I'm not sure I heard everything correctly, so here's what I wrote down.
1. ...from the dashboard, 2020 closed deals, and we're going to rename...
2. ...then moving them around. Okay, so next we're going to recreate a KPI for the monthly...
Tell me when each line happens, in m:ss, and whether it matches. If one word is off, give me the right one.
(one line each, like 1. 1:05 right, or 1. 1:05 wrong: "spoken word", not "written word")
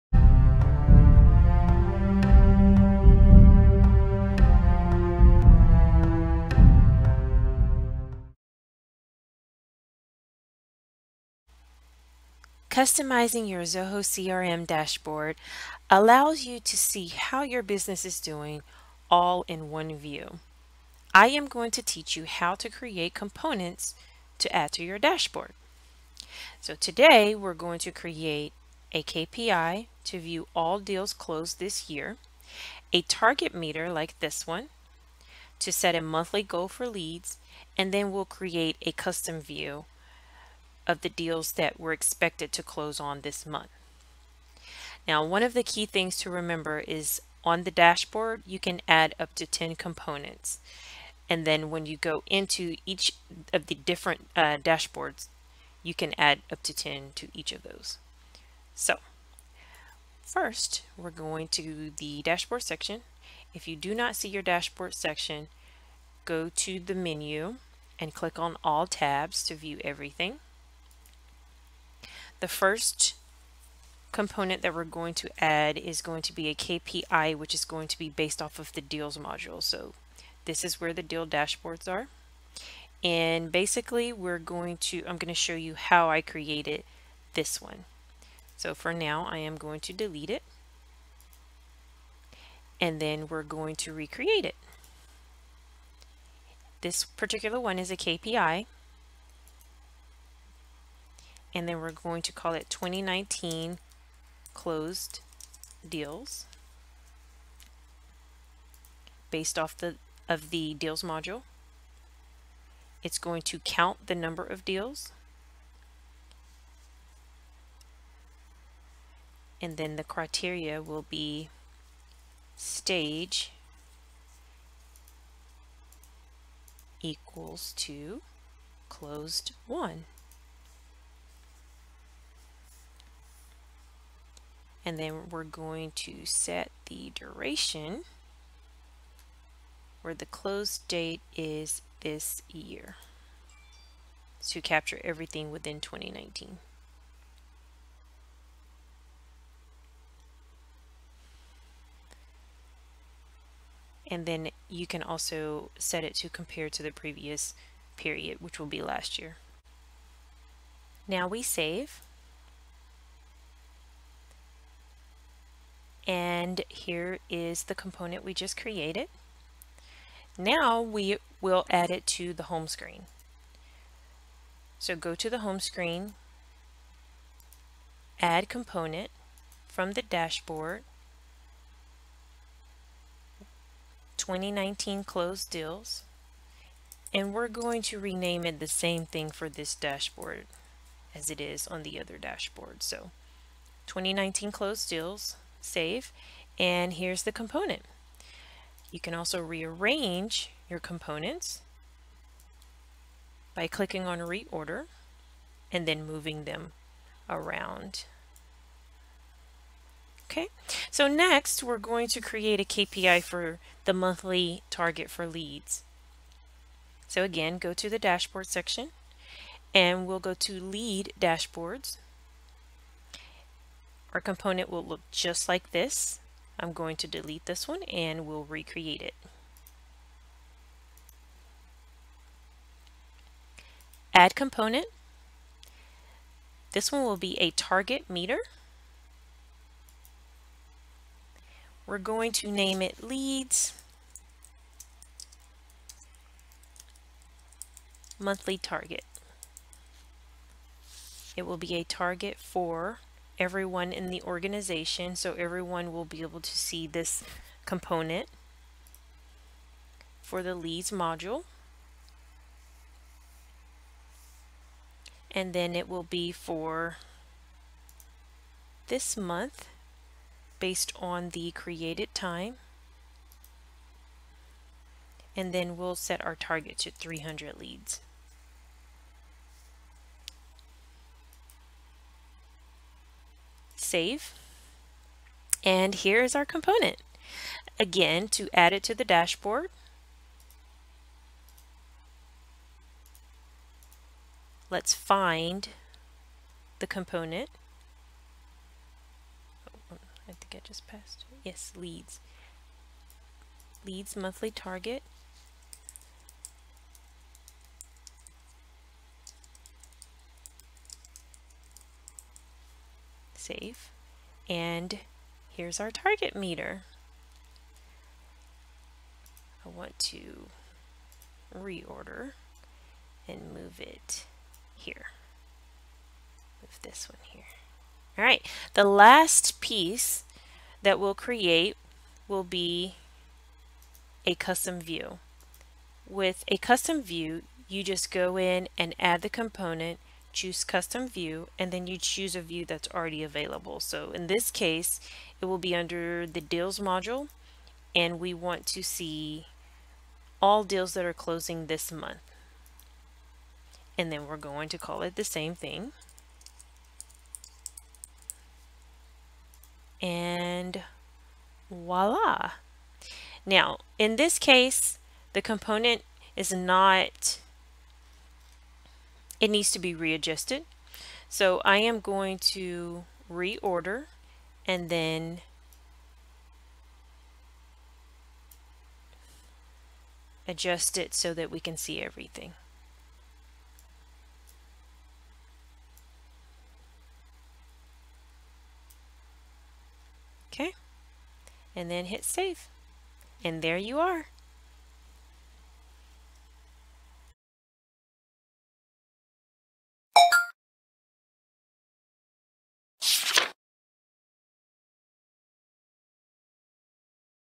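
1. 2:59 wrong: "2019", not "2020"
2. 3:25 wrong: "create", not "recreate".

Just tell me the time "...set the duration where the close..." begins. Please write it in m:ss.
2:16.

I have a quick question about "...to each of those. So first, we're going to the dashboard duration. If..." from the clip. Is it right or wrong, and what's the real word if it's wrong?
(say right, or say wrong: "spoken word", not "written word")
wrong: "section", not "duration".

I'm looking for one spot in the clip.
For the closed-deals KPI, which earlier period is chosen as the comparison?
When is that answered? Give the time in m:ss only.
2:38.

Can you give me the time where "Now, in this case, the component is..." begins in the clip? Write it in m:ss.
6:03.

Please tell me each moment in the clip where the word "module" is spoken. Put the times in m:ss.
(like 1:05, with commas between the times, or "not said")
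1:19, 1:51, 4:20, 5:46.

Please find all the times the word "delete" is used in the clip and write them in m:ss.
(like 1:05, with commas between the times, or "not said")
1:29, 3:47.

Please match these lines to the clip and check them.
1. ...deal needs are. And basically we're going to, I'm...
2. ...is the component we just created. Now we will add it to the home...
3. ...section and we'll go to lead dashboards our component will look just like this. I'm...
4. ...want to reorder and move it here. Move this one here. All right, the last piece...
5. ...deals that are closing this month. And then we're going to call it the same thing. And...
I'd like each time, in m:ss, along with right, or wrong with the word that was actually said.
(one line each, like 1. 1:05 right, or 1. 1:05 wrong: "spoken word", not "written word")
1. 1:21 wrong: "dashboards", not "needs"
2. 2:47 right
3. 3:38 right
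4. 5:19 right
5. 5:50 right.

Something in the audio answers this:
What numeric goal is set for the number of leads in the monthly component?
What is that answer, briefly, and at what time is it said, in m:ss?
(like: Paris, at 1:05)
300, at 4:36.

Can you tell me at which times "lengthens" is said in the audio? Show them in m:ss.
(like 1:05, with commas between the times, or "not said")
not said.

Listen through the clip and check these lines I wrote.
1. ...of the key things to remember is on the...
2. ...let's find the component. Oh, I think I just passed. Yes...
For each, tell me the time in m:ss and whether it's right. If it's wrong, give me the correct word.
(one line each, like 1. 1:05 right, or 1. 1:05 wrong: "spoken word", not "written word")
1. 0:45 right
2. 4:54 right.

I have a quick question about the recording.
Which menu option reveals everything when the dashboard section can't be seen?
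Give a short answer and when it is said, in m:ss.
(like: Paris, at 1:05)
all tabs, at 1:08.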